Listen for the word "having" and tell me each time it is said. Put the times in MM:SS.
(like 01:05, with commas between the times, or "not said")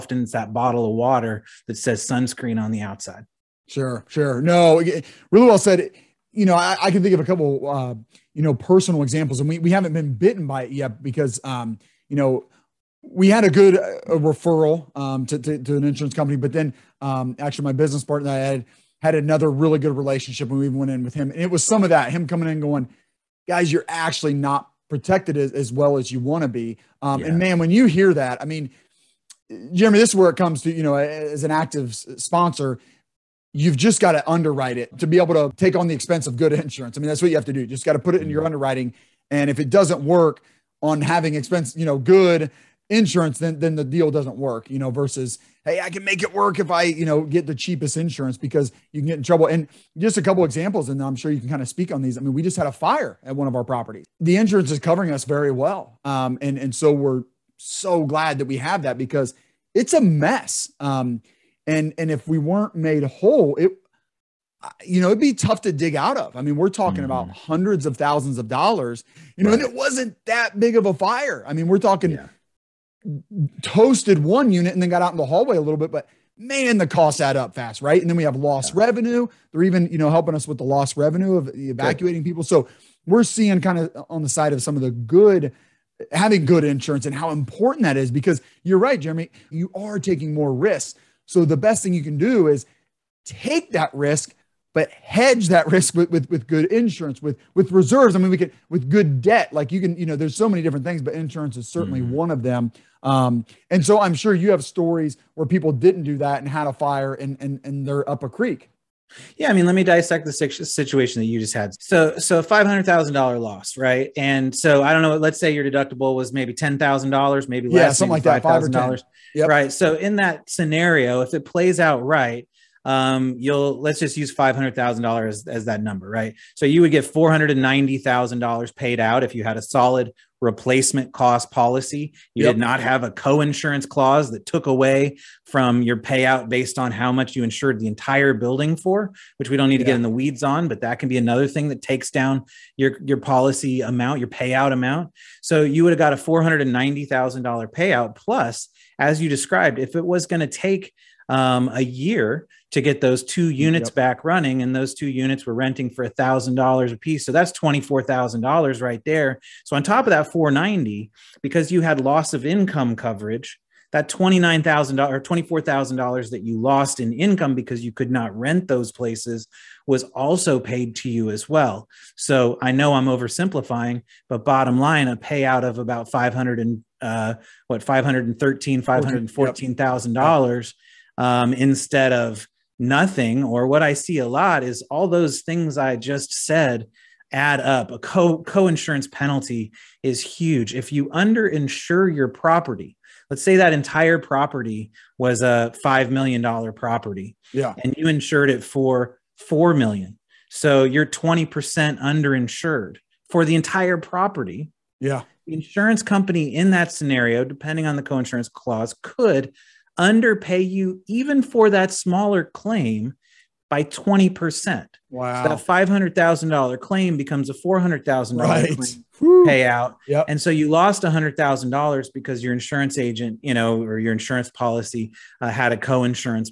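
00:41, 01:26.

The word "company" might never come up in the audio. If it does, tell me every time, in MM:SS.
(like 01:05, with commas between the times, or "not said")
00:16, 03:26.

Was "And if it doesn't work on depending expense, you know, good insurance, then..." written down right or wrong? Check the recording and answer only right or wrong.
wrong.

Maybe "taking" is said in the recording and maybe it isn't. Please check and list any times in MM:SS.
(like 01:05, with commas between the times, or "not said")
01:29.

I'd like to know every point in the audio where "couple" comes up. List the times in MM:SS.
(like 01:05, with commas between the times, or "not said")
00:07, 00:50.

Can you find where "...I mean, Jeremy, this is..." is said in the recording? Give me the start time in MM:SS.
00:28.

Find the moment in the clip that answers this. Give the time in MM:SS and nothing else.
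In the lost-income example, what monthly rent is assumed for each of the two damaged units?
02:36.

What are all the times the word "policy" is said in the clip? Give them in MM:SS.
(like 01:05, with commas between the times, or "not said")
02:11, 02:23, 03:44.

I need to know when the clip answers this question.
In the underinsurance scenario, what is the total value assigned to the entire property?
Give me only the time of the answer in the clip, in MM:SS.
03:15.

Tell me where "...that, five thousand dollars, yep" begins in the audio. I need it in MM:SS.
01:58.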